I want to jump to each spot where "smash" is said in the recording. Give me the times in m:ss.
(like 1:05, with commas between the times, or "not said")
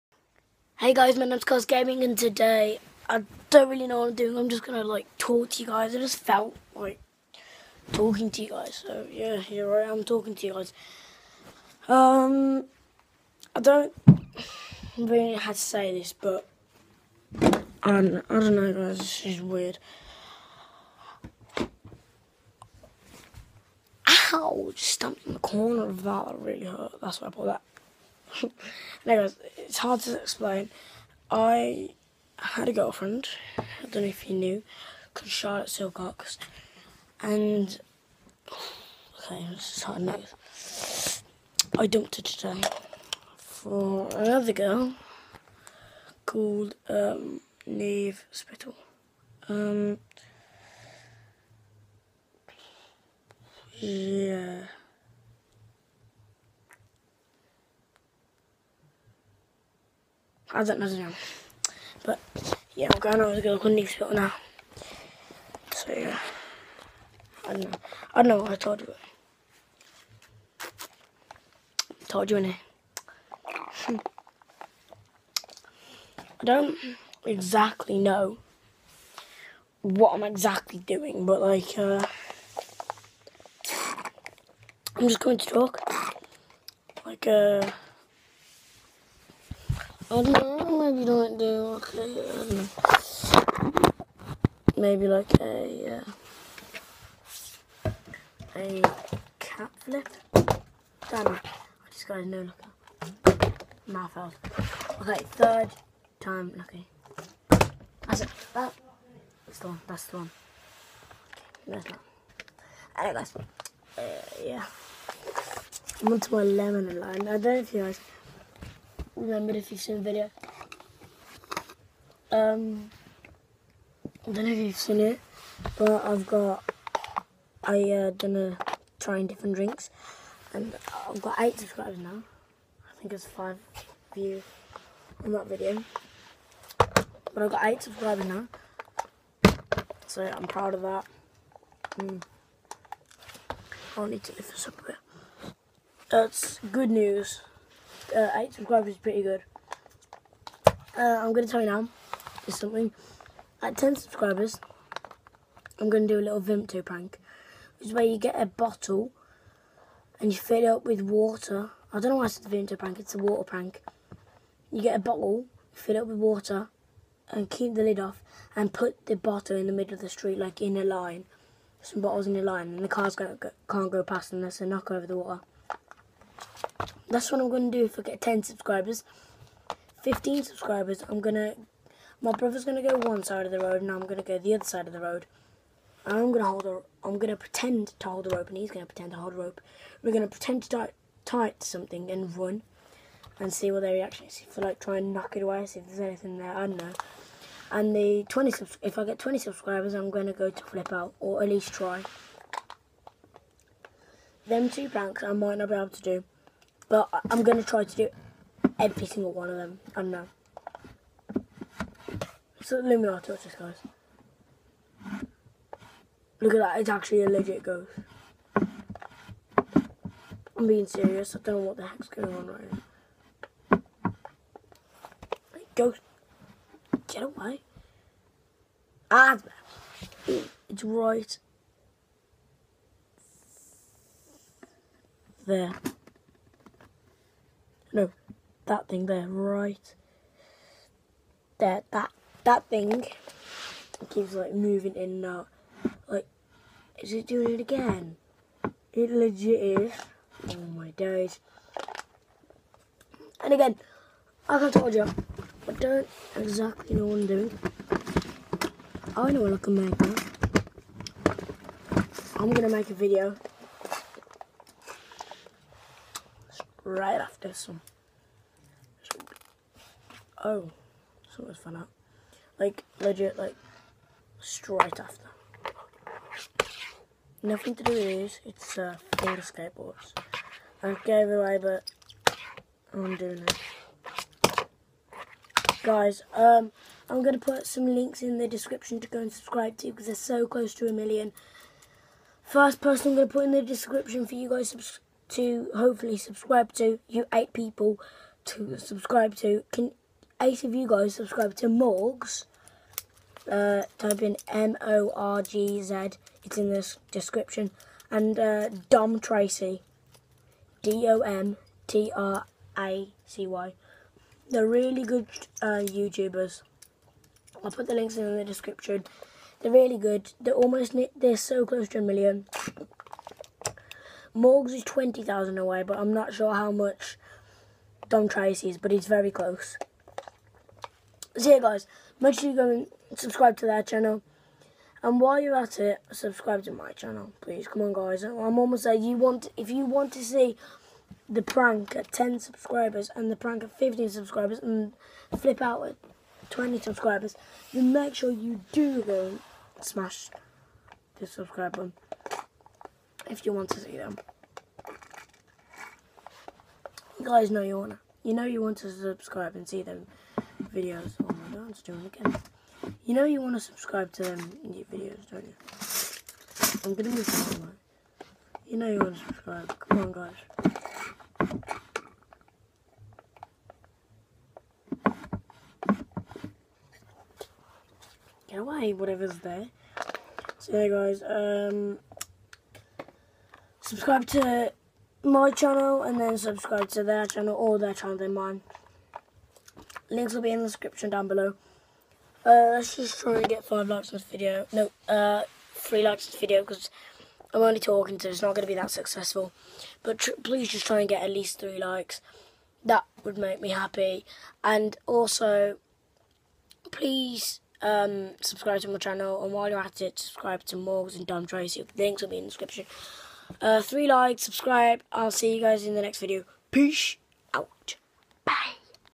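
5:49.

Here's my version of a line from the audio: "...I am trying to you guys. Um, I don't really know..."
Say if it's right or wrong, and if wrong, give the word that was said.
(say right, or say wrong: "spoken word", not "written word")
wrong: "talking", not "trying".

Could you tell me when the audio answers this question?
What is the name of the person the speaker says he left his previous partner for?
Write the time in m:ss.
0:47.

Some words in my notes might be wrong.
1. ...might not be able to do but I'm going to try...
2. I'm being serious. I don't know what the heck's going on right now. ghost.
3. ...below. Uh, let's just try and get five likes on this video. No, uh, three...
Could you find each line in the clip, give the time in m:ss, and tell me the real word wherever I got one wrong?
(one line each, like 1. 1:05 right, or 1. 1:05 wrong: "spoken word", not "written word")
1. 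3:25 right
2. 3:38 right
3. 6:31 right.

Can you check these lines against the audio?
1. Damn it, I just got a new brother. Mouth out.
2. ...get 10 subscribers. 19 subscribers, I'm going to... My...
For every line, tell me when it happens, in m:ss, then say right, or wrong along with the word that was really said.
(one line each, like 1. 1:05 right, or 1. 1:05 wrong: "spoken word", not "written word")
1. 1:41 wrong: "looker", not "brother"
2. 2:58 wrong: "15", not "19".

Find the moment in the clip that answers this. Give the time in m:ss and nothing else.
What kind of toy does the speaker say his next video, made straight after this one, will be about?
4:39.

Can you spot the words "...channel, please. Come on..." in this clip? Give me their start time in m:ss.
5:36.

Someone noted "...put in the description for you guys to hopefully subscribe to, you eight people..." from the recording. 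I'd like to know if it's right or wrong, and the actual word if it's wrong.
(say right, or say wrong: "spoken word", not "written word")
right.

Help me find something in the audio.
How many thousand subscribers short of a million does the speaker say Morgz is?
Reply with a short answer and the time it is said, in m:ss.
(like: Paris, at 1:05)
20,000, at 5:24.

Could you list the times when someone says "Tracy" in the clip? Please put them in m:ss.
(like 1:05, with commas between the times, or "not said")
5:09, 5:28, 6:51.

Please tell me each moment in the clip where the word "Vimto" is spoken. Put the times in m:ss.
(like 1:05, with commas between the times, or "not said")
2:36, 2:42.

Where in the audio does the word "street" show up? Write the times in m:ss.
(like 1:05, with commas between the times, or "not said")
2:50.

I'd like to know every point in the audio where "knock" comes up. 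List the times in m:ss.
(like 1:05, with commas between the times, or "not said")
2:54, 3:15.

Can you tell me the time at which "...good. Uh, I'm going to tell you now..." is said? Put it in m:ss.
2:29.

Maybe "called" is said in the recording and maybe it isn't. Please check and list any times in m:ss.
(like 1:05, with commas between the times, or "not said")
0:35, 0:46.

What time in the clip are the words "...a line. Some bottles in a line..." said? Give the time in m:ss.
2:50.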